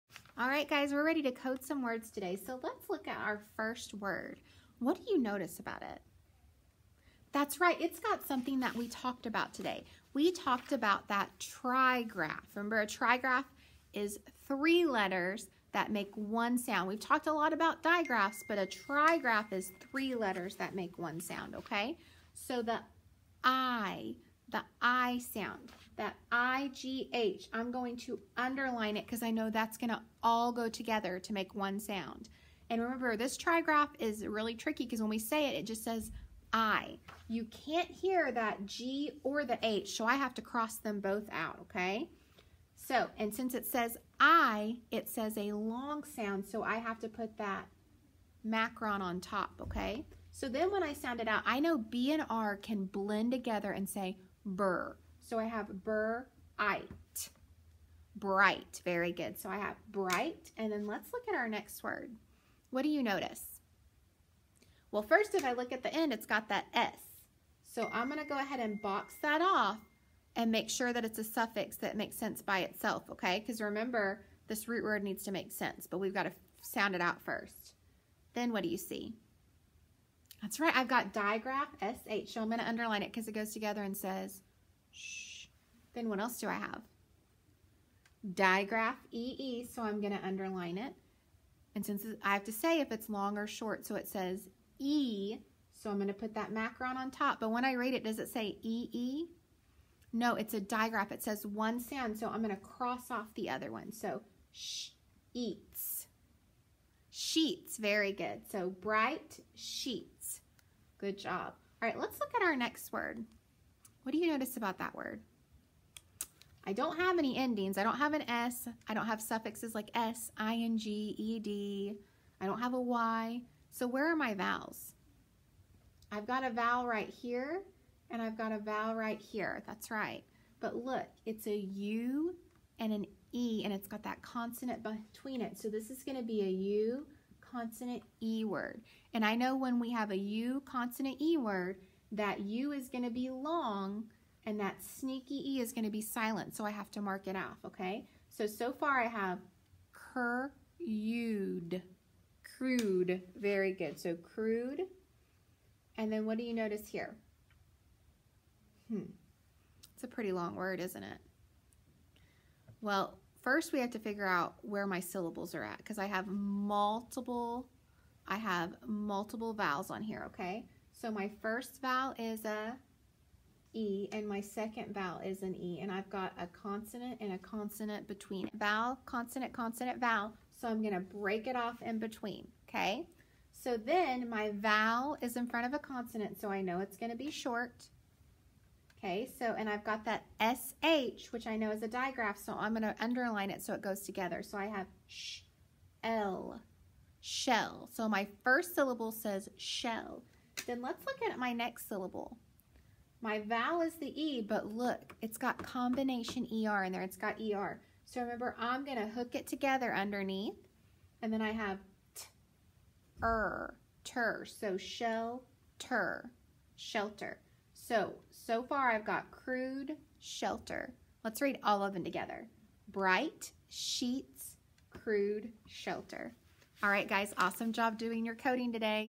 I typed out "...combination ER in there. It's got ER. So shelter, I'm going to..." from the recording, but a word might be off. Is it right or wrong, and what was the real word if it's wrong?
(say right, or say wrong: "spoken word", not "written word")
wrong: "remember", not "shelter".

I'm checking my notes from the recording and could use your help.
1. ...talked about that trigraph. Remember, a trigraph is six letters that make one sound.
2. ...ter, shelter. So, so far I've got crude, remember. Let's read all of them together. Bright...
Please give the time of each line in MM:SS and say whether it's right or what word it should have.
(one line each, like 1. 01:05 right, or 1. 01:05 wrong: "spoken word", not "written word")
1. 00:10 wrong: "three", not "six"
2. 03:35 wrong: "shelter", not "remember".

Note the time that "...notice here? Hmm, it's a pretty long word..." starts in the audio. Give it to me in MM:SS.
02:36.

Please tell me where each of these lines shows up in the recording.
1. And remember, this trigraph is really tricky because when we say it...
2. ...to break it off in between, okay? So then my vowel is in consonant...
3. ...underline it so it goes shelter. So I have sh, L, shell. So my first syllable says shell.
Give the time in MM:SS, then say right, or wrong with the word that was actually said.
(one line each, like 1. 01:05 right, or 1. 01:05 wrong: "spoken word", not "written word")
1. 00:32 right
2. 03:00 wrong: "front", not "consonant"
3. 03:12 wrong: "together", not "shelter".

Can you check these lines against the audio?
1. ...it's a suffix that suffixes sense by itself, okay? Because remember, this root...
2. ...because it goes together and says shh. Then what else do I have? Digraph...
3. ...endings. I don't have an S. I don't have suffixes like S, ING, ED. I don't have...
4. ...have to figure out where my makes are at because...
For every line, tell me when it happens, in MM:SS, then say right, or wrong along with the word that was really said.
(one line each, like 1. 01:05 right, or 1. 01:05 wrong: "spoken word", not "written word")
1. 01:11 wrong: "makes", not "suffixes"
2. 01:23 right
3. 01:57 right
4. 02:43 wrong: "syllables", not "makes".